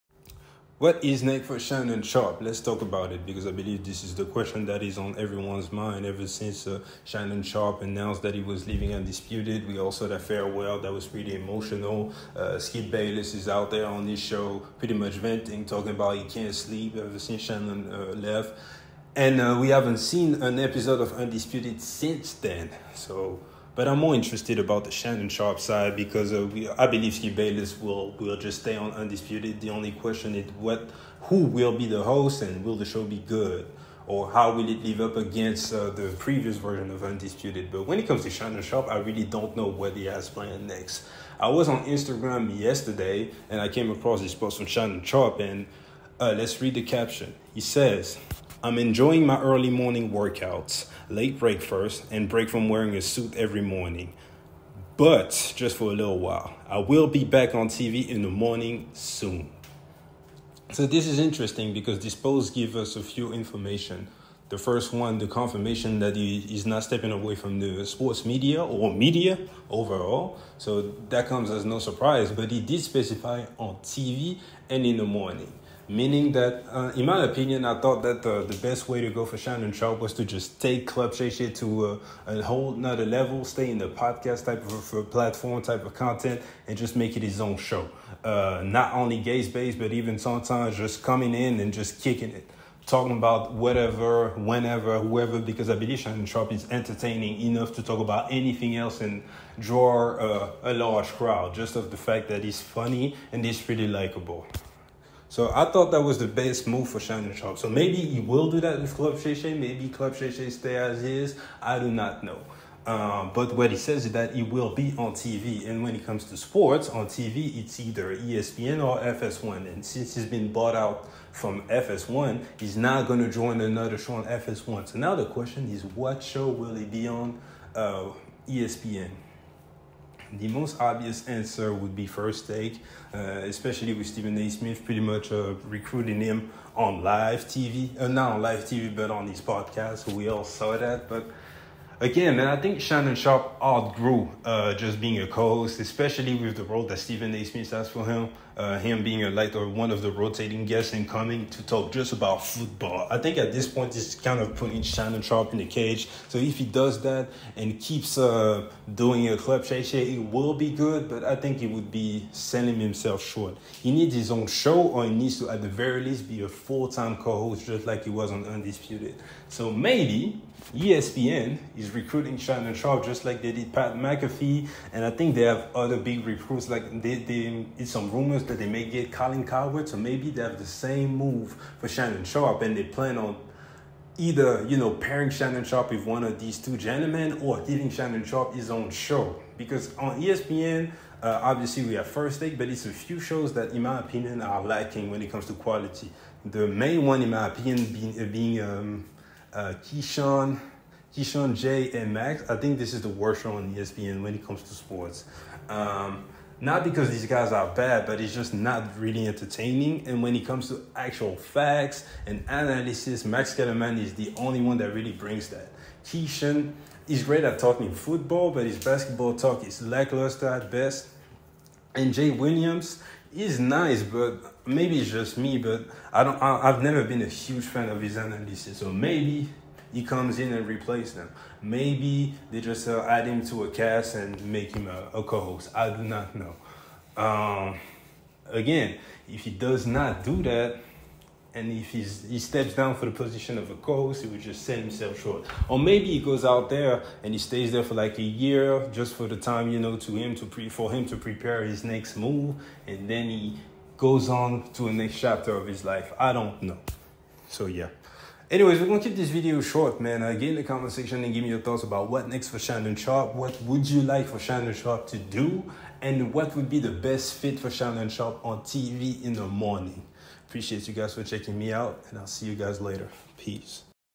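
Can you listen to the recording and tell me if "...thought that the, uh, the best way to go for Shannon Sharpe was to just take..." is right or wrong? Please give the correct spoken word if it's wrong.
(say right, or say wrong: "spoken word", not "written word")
right.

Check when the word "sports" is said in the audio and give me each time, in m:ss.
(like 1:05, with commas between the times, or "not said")
1:07, 1:56, 3:24.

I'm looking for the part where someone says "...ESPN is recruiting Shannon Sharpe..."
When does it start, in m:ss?
2:50.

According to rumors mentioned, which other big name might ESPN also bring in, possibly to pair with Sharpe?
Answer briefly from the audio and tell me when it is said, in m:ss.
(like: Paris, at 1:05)
Colin Cowherd, at 2:59.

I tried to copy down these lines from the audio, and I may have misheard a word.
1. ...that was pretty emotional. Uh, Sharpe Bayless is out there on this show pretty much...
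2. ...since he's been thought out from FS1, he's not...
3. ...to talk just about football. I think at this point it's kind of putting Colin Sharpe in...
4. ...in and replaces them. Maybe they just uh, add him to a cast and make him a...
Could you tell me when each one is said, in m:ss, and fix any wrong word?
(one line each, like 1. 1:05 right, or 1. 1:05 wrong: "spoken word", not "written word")
1. 0:10 wrong: "Skip", not "Sharpe"
2. 1:59 wrong: "bought", not "thought"
3. 2:31 wrong: "Shannon", not "Colin"
4. 3:50 right.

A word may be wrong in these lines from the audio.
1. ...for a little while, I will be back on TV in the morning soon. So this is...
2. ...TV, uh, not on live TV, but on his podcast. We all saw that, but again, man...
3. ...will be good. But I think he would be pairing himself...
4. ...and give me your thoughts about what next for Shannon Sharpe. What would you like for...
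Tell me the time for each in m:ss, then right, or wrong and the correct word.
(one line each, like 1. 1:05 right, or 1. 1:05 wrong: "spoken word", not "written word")
1. 0:55 right
2. 2:17 right
3. 2:40 wrong: "selling", not "pairing"
4. 4:21 right.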